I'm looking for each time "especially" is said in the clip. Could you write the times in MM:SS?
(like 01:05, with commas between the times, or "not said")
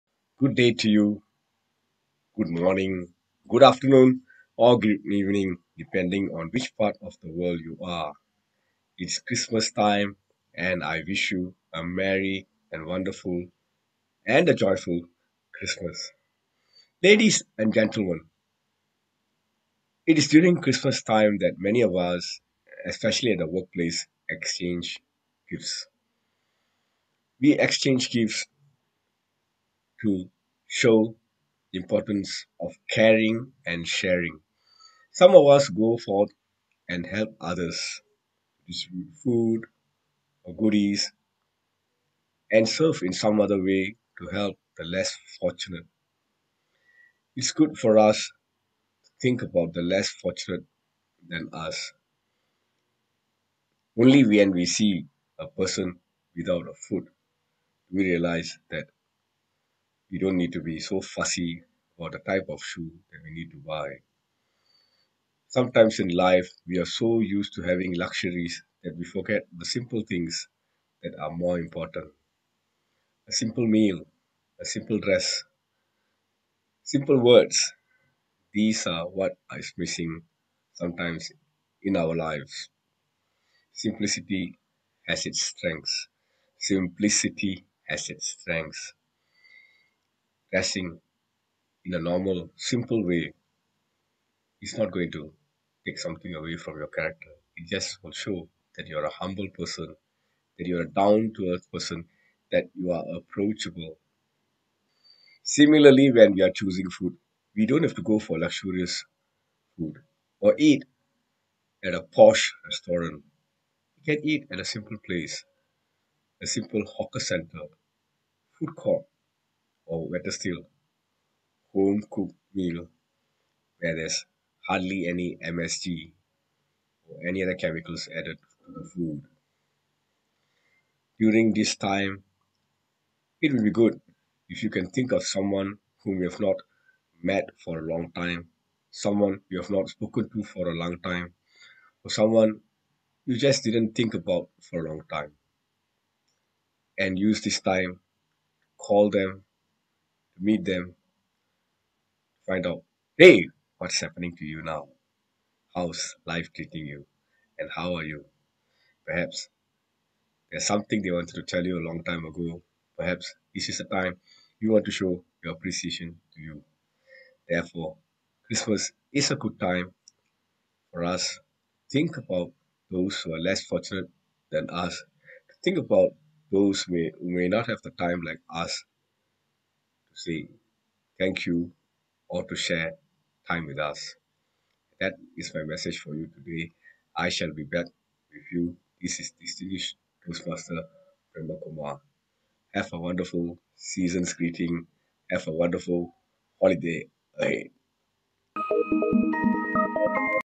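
00:22.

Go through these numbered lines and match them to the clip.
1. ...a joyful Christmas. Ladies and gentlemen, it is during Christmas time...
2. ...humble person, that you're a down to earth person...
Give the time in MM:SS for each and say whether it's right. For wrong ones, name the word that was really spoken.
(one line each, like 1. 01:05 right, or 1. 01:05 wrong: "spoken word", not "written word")
1. 00:14 right
2. 01:39 right.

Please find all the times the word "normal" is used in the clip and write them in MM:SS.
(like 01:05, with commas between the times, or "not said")
01:31.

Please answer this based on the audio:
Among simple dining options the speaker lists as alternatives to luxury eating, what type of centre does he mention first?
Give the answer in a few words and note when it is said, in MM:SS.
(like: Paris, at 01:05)
hawker center, at 01:56.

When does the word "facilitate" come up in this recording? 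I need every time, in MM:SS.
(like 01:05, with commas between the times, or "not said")
not said.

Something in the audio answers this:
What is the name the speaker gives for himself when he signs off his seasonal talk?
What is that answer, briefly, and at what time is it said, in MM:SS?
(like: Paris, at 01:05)
Brahma Kumar, at 03:11.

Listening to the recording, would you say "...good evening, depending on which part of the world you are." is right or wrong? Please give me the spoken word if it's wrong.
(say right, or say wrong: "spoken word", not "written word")
right.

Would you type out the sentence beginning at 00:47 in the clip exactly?
It's good for us to think about the less fortunate than us.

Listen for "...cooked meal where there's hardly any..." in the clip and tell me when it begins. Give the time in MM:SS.
02:02.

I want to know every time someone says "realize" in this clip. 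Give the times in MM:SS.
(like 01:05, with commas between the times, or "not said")
00:58.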